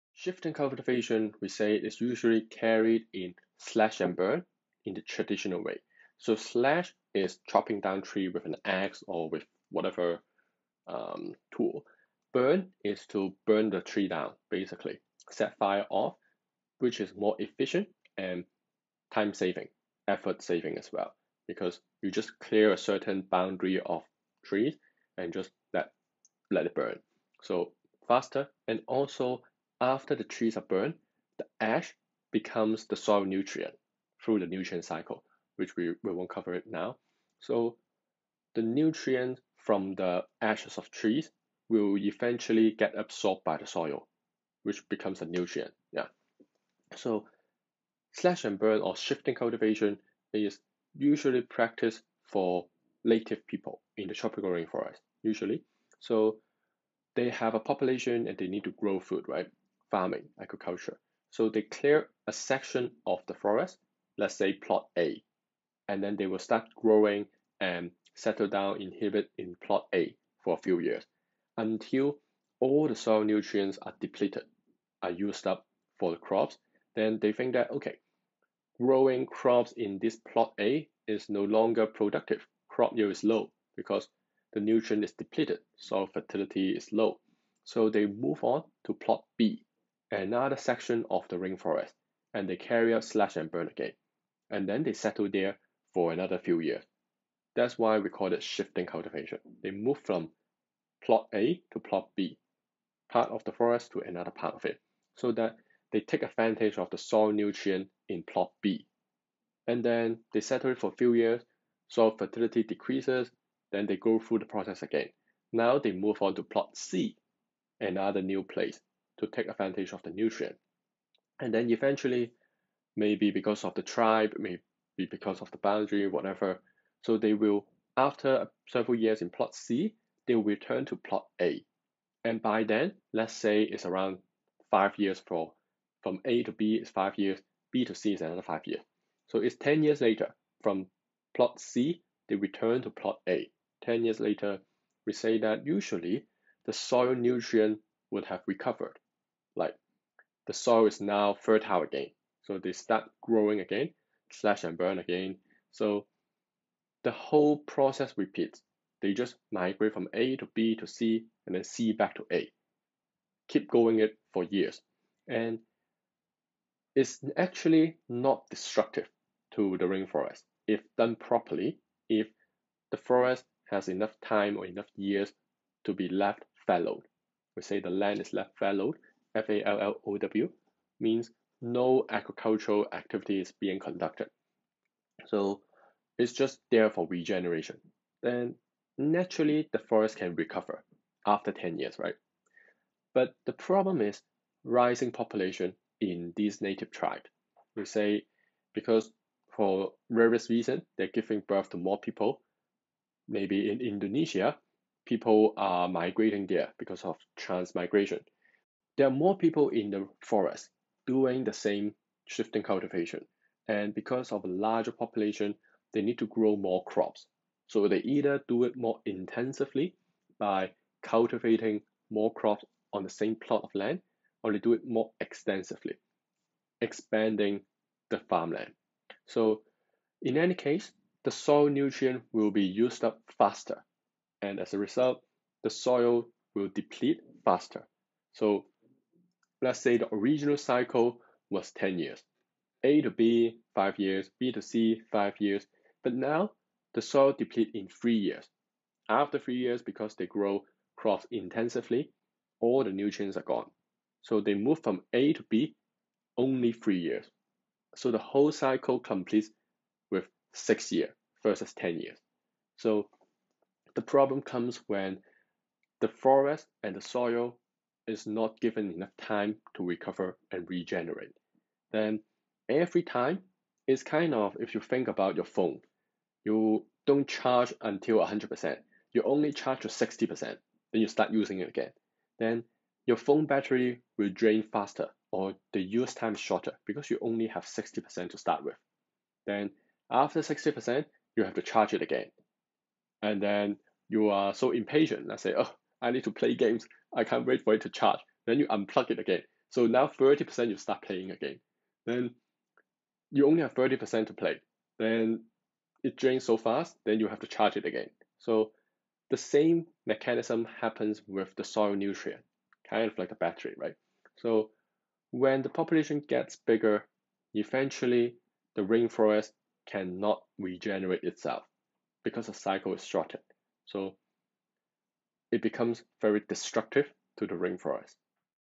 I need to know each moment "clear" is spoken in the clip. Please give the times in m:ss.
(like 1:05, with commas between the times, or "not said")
0:22, 1:01.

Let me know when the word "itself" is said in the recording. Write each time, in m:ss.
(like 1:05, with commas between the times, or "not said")
5:21.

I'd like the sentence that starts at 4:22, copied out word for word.
So the problem comes when the forest and the soil is not given enough time to recover and regenerate.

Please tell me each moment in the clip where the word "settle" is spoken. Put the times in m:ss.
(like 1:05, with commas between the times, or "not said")
1:08, 1:34, 1:50.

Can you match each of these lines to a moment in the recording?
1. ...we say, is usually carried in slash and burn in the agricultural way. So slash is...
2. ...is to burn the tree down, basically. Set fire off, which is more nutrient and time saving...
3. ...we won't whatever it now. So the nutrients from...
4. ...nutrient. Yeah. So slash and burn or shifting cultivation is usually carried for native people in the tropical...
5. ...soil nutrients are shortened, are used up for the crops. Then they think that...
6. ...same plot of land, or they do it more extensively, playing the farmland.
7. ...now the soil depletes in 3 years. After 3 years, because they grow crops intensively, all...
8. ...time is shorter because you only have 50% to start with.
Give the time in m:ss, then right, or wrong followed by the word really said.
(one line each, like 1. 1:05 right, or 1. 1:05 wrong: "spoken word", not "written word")
1. 0:01 wrong: "traditional", not "agricultural"
2. 0:12 wrong: "efficient", not "nutrient"
3. 0:36 wrong: "cover", not "whatever"
4. 0:45 wrong: "practiced", not "carried"
5. 1:12 wrong: "depleted", not "shortened"
6. 3:43 wrong: "expanding", not "playing"
7. 4:06 right
8. 4:46 wrong: "60", not "50".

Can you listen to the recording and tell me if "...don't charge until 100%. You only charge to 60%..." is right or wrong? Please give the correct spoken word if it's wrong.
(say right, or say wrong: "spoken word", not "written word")
right.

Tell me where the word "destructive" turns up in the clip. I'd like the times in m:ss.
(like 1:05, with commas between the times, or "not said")
2:48, 5:26.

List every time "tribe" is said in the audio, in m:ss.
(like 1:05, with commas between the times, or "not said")
2:03, 3:16.